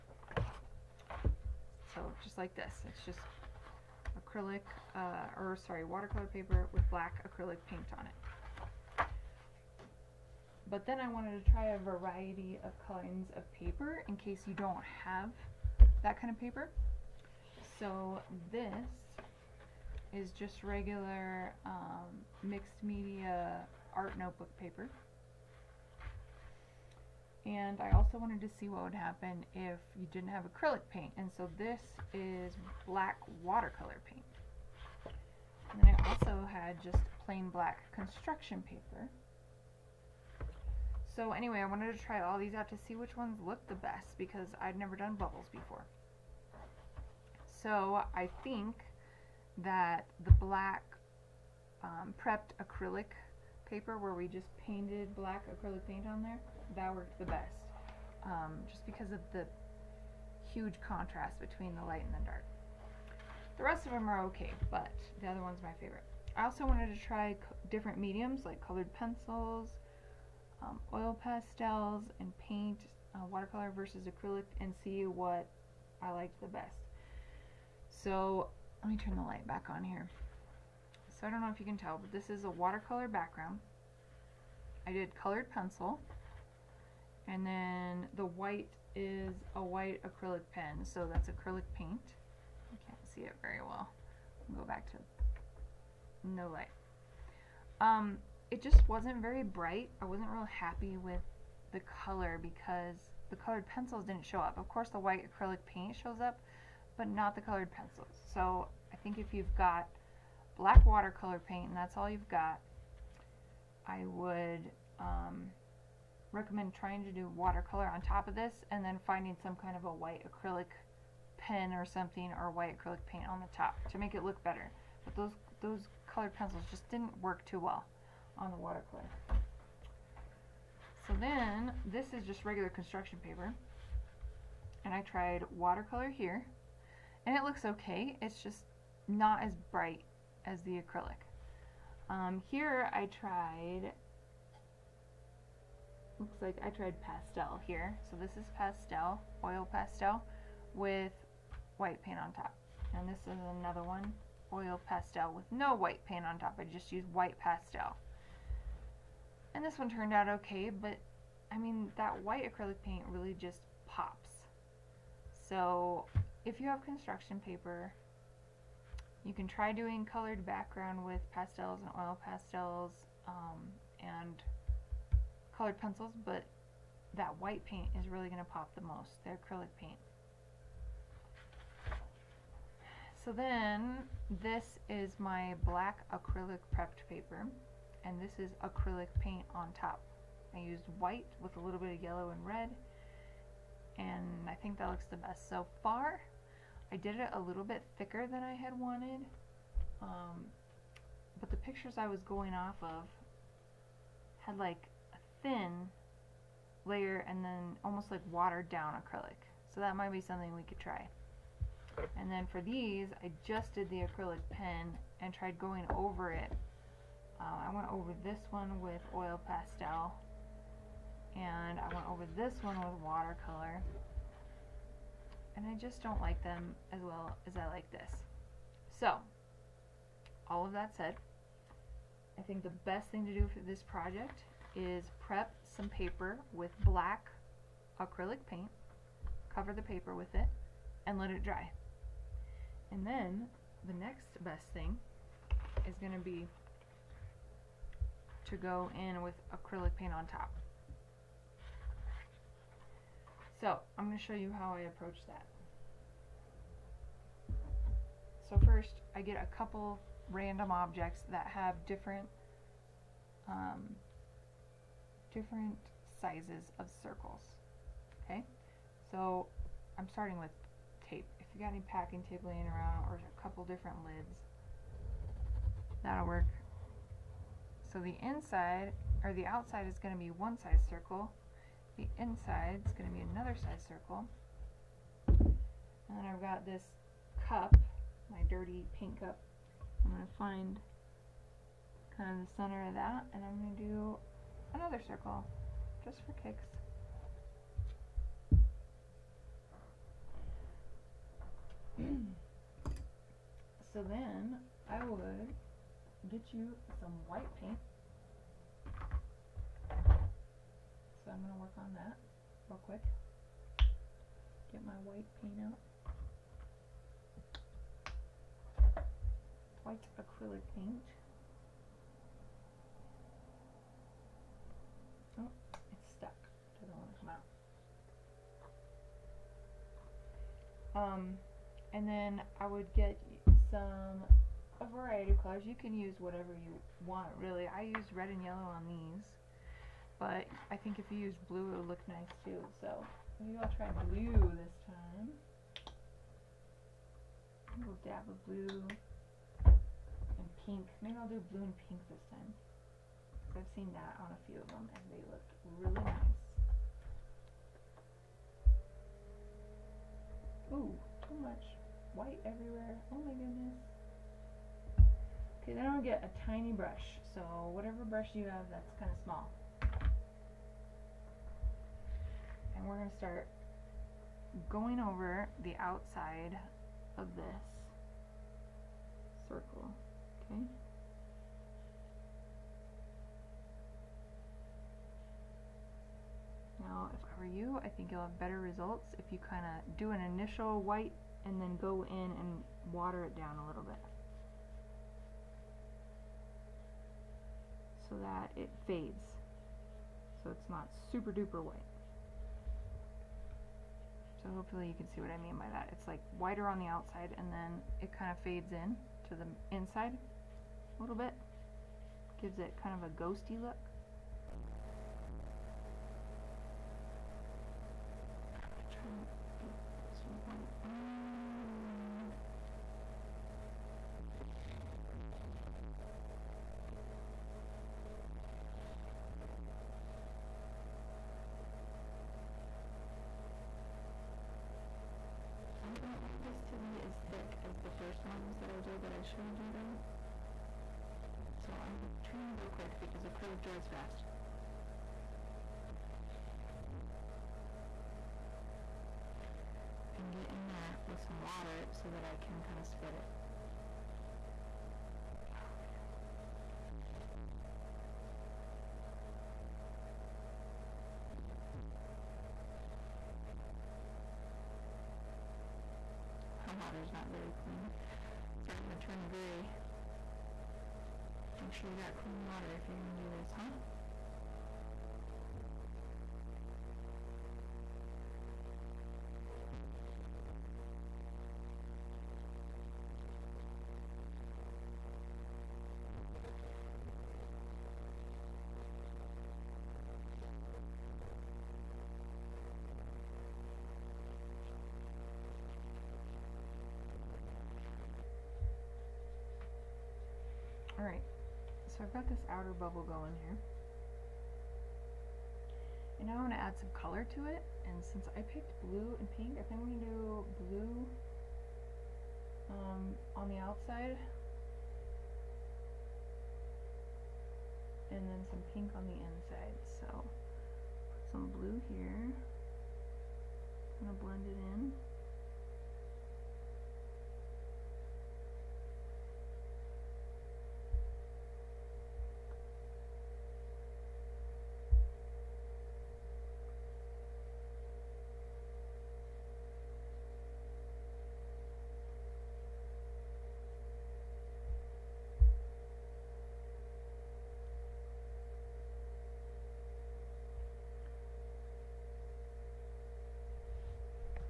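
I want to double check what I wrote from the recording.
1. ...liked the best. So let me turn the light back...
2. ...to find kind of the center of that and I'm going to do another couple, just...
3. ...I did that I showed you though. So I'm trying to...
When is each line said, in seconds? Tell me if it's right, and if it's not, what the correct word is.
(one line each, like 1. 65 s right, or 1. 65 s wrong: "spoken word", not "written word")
1. 76 s right
2. 290 s wrong: "circle", not "couple"
3. 438 s right.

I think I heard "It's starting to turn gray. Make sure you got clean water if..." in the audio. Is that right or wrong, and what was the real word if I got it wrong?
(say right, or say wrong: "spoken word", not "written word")
right.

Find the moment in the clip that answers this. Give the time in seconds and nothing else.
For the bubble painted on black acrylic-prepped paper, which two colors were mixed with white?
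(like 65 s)
192 s.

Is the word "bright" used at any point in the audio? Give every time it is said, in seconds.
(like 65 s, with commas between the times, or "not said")
99 s, 139 s.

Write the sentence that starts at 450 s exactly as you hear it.
and get in there with some water so that I can kind of spread it.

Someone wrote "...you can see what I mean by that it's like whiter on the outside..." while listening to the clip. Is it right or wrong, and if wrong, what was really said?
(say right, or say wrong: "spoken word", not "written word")
right.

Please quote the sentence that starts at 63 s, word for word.
The rest of them are okay, but the other one's my favorite.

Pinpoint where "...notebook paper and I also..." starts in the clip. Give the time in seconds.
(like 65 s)
24 s.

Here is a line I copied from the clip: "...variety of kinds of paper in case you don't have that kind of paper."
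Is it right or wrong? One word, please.
right.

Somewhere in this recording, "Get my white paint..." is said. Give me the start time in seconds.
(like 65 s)
314 s.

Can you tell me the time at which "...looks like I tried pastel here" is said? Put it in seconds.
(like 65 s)
146 s.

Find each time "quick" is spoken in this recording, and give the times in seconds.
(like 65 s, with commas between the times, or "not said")
312 s, 442 s.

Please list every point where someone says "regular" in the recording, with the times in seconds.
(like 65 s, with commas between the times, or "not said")
20 s, 132 s.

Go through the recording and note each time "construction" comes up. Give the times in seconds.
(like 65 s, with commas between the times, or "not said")
37 s, 132 s, 166 s.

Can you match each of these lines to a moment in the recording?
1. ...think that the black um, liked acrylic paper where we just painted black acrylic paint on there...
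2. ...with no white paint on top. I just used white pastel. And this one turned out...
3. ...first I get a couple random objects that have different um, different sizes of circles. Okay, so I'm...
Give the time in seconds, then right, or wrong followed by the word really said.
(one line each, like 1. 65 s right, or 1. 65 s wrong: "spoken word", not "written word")
1. 48 s wrong: "prepped", not "liked"
2. 155 s right
3. 258 s right.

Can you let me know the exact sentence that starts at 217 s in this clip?
Uh, I went over this one with oil pastel and I went over this one with watercolor.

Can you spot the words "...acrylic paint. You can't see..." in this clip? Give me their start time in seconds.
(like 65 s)
91 s.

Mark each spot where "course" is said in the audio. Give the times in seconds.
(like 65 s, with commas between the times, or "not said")
104 s.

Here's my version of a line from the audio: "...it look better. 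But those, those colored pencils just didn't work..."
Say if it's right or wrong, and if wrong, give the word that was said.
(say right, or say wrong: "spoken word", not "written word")
right.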